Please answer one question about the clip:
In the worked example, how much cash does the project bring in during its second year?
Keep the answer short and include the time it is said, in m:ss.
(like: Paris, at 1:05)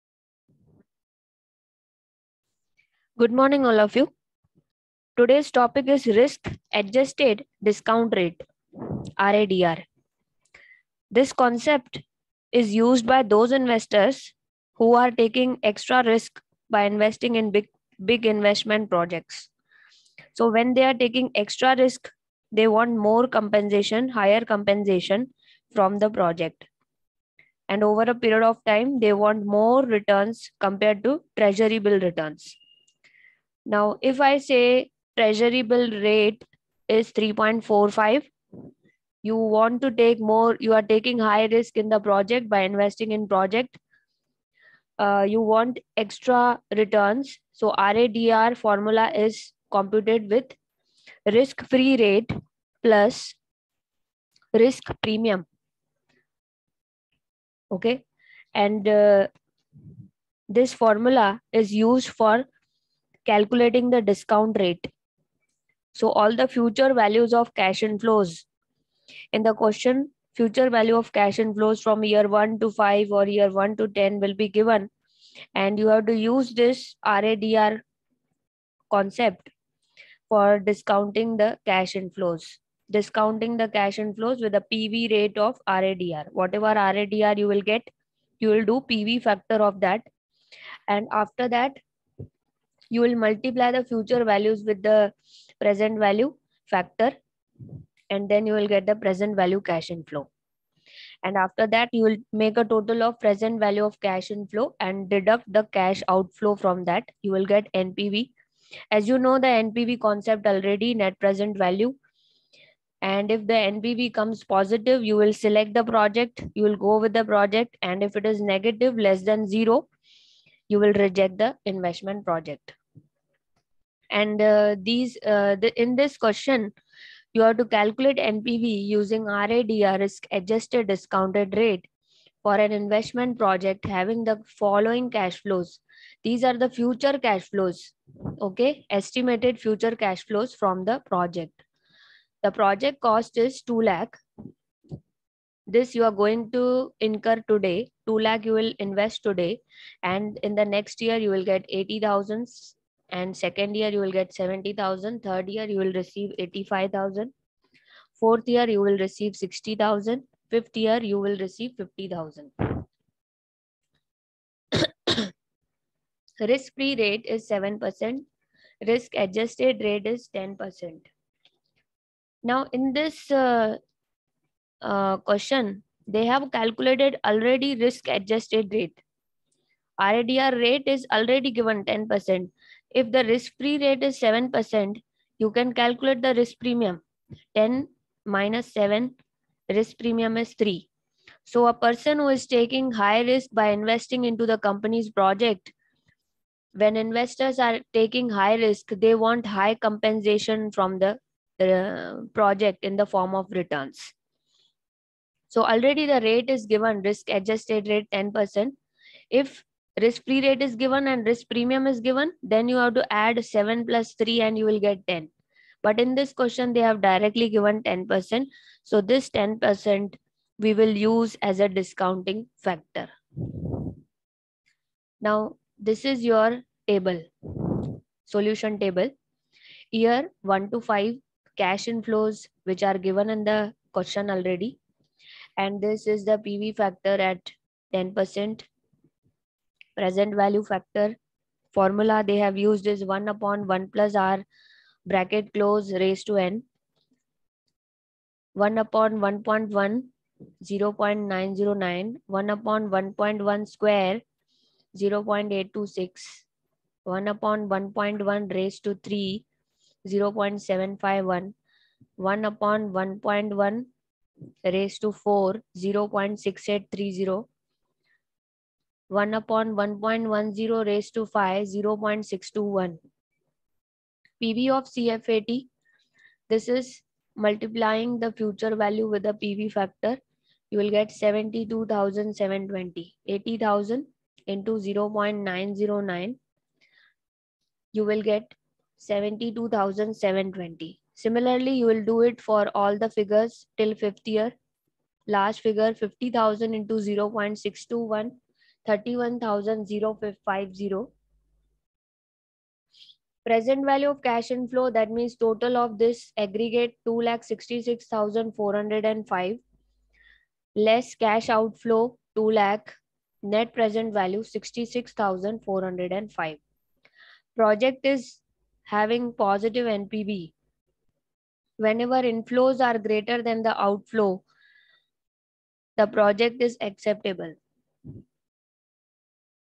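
70000, at 2:34.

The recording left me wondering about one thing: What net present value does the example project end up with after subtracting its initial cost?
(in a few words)
66,405.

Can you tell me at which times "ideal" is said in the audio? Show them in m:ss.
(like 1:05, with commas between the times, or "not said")
not said.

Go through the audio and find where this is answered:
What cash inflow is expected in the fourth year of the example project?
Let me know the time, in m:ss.
2:39.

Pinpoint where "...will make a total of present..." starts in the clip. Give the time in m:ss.
1:42.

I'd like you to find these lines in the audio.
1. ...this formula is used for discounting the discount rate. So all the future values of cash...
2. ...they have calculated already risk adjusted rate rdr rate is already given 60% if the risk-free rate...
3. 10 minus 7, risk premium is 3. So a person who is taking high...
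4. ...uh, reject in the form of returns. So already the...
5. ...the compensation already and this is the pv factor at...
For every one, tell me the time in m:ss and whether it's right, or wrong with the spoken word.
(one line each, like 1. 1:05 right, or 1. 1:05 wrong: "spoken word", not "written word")
1. 1:00 wrong: "calculating", not "discounting"
2. 2:56 wrong: "10", not "60"
3. 3:07 right
4. 3:21 wrong: "project", not "reject"
5. 3:53 wrong: "question", not "compensation".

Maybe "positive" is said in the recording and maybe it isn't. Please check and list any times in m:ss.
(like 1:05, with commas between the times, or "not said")
1:54, 5:19.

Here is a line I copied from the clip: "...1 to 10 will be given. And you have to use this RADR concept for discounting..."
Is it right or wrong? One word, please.
right.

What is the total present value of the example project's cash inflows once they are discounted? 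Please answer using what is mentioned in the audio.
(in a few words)
2,66,405.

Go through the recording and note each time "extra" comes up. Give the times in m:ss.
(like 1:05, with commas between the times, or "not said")
0:15, 0:21, 0:45.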